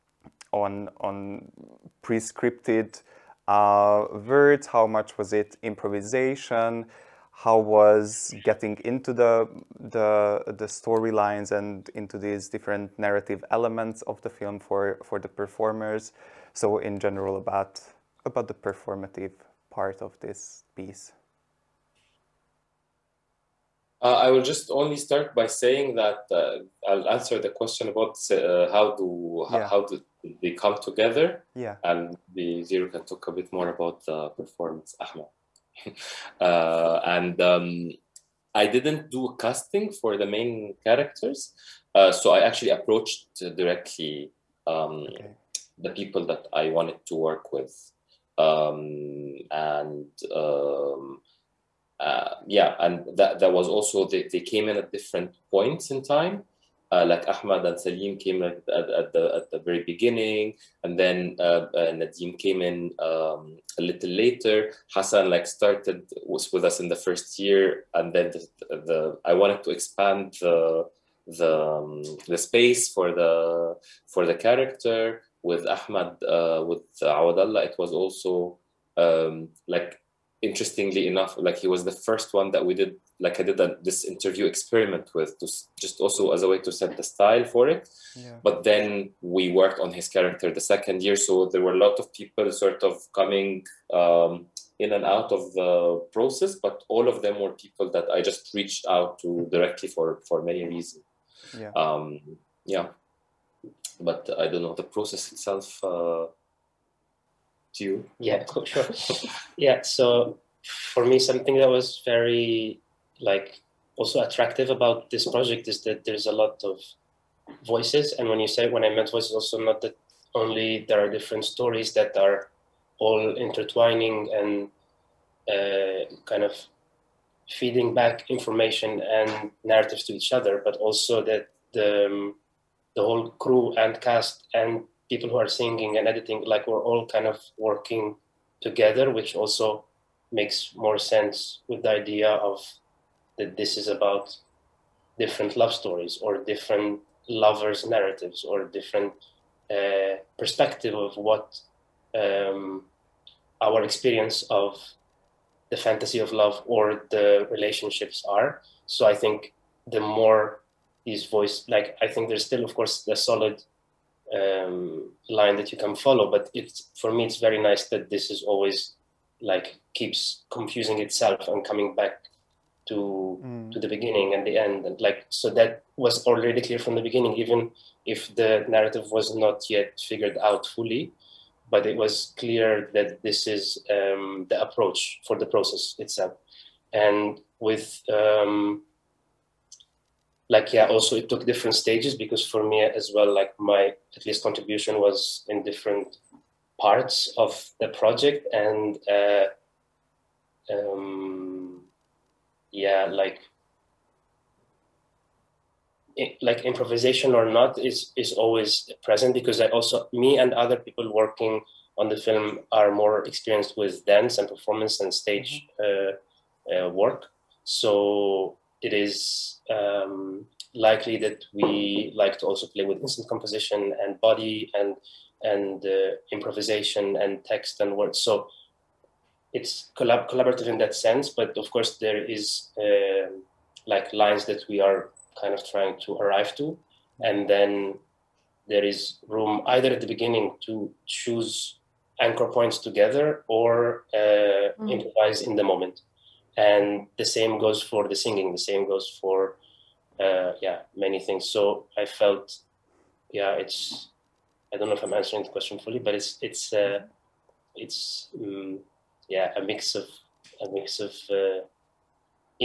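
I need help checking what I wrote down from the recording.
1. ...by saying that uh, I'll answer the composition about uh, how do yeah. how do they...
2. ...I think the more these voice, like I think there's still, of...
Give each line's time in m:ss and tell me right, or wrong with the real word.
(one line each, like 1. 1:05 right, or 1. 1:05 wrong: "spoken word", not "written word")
1. 0:25 wrong: "question", not "composition"
2. 2:39 right.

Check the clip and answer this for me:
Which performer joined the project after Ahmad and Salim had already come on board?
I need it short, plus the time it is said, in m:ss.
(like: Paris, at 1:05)
Nadim, at 1:01.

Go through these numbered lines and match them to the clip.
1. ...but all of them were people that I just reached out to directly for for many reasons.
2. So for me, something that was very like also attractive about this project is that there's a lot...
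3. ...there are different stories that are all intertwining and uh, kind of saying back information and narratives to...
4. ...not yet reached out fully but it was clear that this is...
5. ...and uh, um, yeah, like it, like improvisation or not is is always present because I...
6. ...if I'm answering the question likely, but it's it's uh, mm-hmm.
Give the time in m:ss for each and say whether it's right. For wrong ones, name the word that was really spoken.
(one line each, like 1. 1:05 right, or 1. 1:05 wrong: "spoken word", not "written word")
1. 1:36 right
2. 1:49 right
3. 2:00 wrong: "feeding", not "saying"
4. 2:59 wrong: "figured", not "reached"
5. 3:18 right
6. 4:14 wrong: "fully", not "likely".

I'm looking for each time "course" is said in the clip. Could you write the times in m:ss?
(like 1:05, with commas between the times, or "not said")
2:42, 3:51.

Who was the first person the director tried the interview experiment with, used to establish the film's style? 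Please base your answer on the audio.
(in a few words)
Awadallah.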